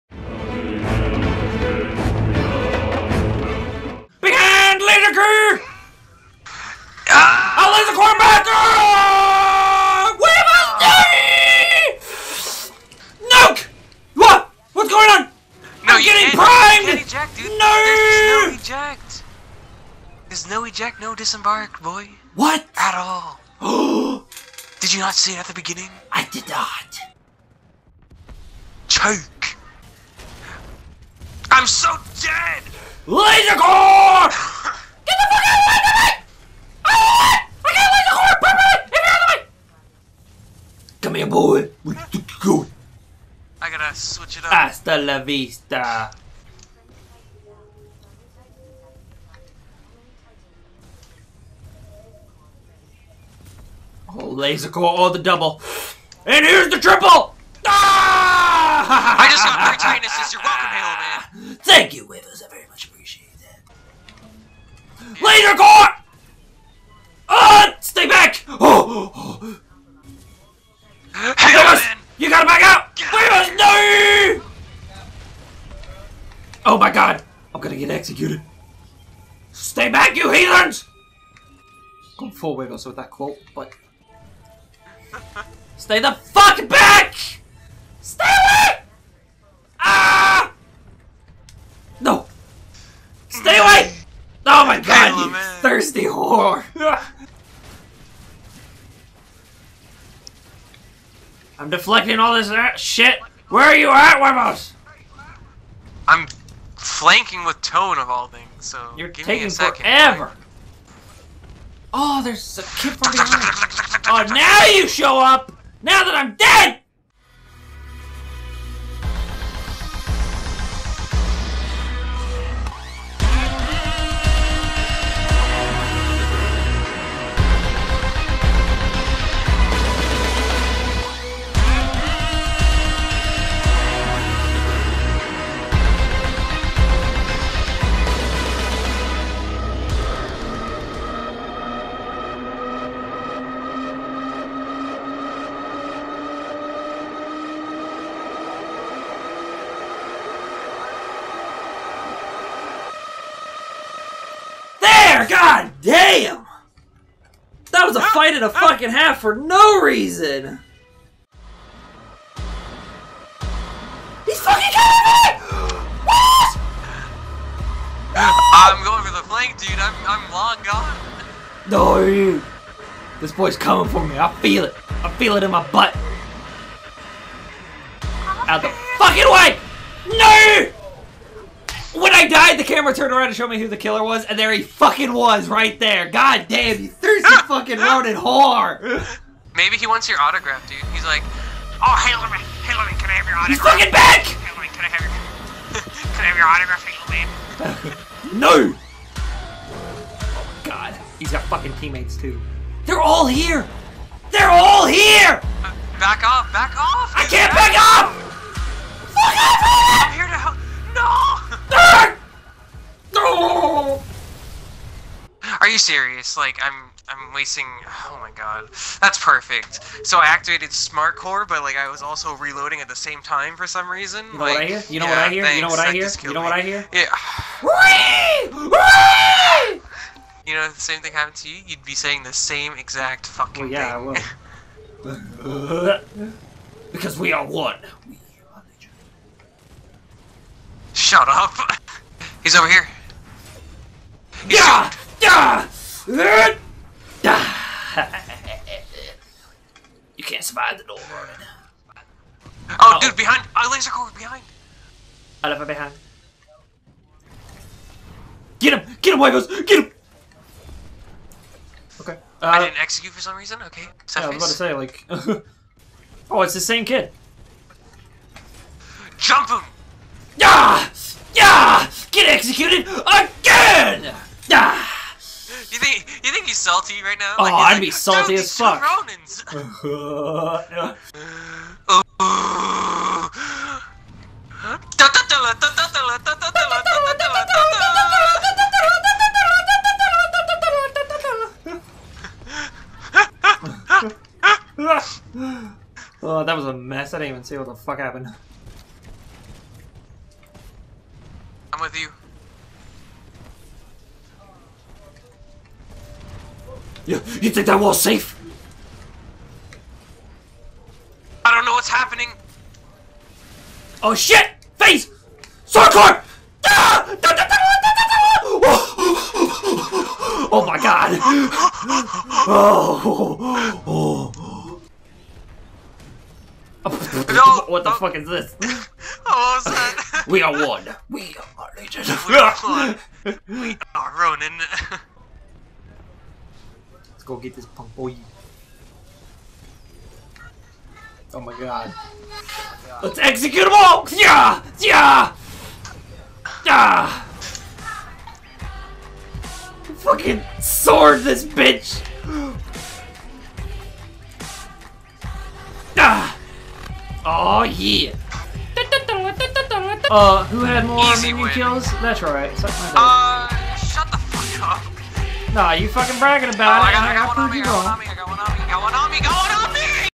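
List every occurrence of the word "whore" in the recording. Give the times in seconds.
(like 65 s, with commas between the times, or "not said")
96 s, 188 s.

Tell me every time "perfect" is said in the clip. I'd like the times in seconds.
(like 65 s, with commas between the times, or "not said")
38 s, 219 s.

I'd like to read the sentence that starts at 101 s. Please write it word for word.
I'm deflecting all this uh, shit.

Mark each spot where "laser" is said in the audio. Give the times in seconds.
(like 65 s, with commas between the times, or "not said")
33 s, 37 s, 54 s, 65 s, 253 s.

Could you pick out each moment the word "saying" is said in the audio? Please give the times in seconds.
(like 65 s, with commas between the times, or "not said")
231 s.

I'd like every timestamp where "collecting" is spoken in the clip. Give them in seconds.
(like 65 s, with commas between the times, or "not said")
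not said.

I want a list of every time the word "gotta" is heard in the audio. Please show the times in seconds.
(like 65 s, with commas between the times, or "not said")
43 s, 72 s.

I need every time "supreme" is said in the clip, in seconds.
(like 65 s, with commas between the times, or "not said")
not said.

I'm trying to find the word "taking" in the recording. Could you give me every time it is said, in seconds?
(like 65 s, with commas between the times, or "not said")
109 s.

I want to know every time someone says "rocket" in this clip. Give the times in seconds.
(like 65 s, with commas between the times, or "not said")
not said.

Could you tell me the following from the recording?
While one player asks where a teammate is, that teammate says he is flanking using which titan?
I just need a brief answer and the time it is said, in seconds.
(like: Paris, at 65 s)
Tone, at 107 s.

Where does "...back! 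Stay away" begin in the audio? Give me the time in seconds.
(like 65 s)
86 s.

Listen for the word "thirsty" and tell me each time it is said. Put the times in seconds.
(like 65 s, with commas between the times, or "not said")
95 s, 186 s.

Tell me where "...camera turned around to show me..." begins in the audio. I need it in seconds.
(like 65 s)
182 s.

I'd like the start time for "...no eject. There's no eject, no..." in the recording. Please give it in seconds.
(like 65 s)
18 s.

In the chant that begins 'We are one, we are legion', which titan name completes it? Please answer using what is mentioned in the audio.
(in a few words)
Ronin.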